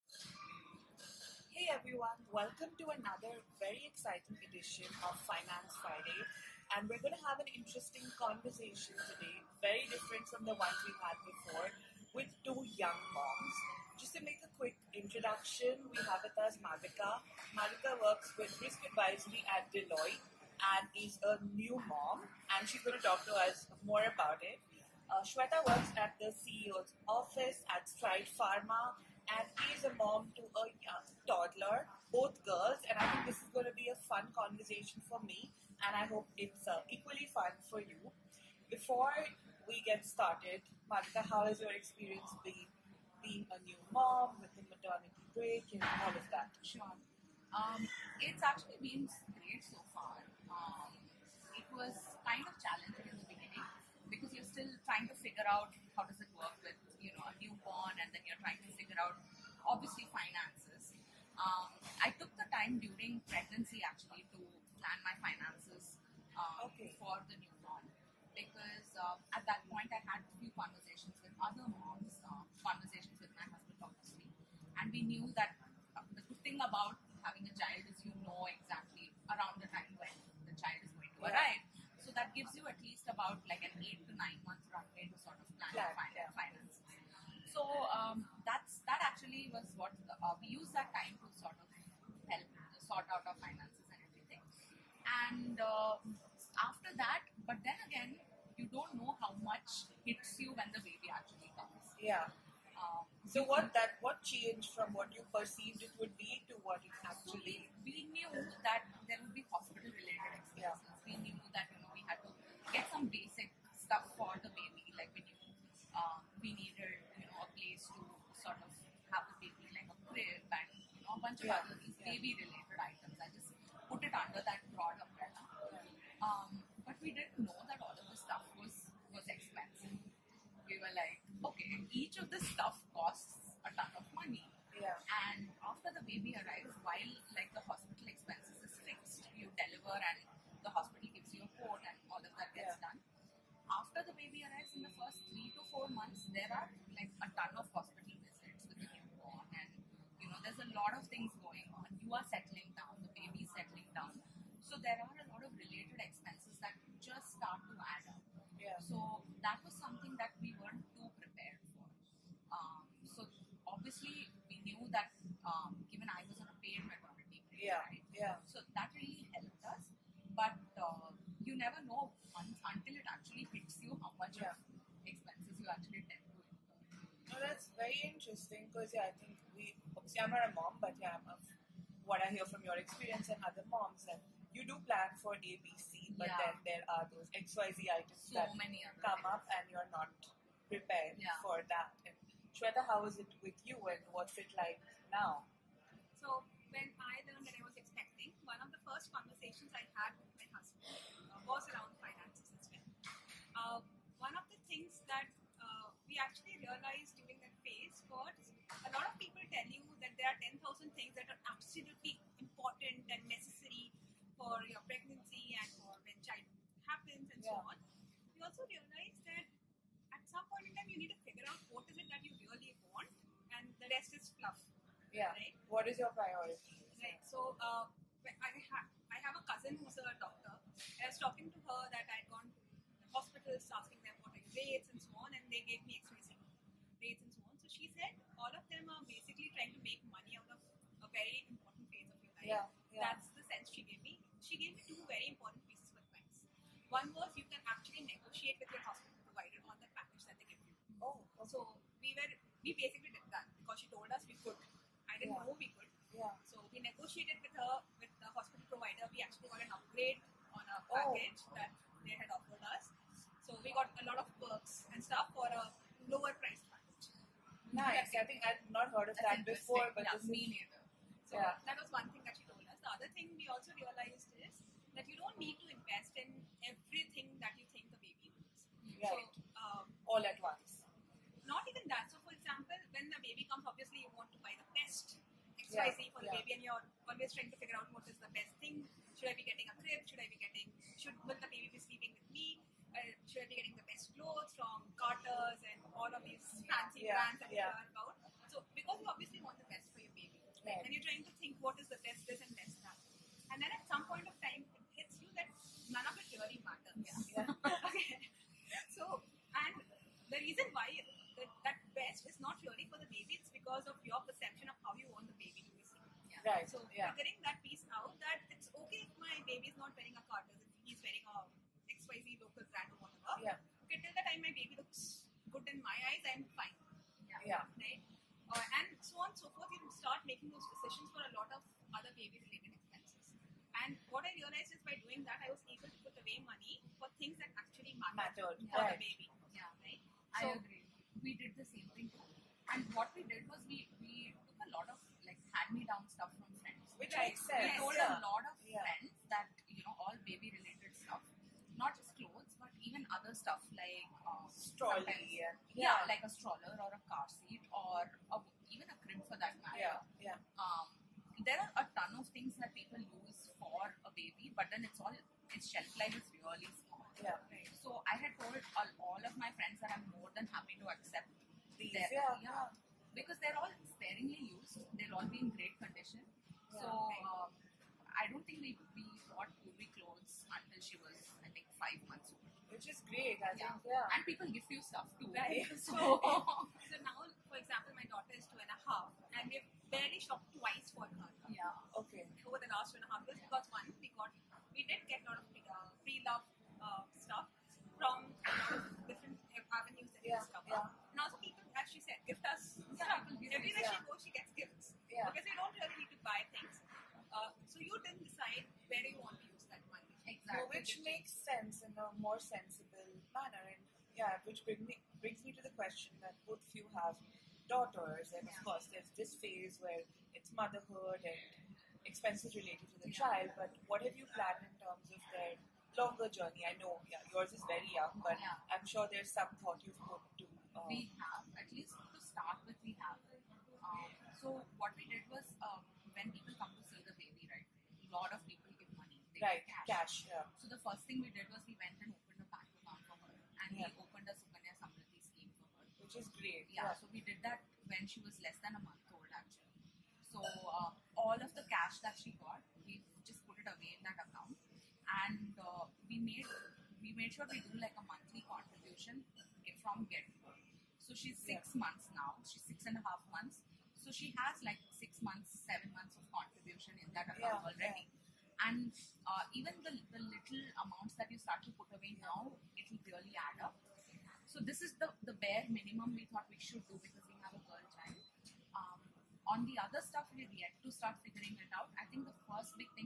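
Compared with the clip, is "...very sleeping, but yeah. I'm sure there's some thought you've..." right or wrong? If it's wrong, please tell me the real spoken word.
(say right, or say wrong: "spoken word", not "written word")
wrong: "young", not "sleeping".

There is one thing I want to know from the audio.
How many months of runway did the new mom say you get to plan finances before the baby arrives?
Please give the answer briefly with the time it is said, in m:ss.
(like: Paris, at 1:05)
8 to 9 months, at 1:23.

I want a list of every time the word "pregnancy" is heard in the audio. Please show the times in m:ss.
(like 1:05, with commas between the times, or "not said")
1:03, 3:34.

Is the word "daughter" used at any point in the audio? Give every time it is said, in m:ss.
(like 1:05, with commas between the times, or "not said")
6:28, 6:57.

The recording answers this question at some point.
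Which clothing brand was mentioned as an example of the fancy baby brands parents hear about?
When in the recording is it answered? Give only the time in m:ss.
4:54.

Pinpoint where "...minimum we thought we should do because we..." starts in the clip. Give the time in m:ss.
7:55.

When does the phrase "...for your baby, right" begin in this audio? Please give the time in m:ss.
4:59.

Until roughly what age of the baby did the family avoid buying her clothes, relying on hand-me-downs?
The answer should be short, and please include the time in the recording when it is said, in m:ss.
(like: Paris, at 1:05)
5 months, at 6:21.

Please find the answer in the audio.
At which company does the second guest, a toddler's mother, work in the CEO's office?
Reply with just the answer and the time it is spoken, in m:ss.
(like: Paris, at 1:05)
Stride Pharma, at 0:27.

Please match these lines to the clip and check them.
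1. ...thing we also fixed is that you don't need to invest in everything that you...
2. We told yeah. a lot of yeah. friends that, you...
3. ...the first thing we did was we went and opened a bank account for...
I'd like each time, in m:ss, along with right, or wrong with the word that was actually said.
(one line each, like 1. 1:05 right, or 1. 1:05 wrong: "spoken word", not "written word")
1. 4:33 wrong: "realized", not "fixed"
2. 5:47 right
3. 7:20 right.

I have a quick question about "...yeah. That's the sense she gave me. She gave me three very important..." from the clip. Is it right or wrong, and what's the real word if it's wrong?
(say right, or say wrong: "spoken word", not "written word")
wrong: "two", not "three".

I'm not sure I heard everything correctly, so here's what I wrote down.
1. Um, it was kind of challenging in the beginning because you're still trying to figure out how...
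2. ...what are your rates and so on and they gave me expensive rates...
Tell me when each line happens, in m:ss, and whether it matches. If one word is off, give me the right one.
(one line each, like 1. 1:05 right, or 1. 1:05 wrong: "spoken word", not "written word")
1. 0:50 right
2. 3:54 right.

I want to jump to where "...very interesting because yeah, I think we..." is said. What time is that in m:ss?
2:57.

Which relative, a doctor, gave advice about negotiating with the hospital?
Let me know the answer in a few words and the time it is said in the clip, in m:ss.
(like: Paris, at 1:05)
Cousin, at 3:49.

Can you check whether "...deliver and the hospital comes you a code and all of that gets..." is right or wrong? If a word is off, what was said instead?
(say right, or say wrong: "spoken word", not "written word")
wrong: "gives", not "comes".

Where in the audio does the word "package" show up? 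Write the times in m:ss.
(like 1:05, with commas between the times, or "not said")
4:09, 4:20.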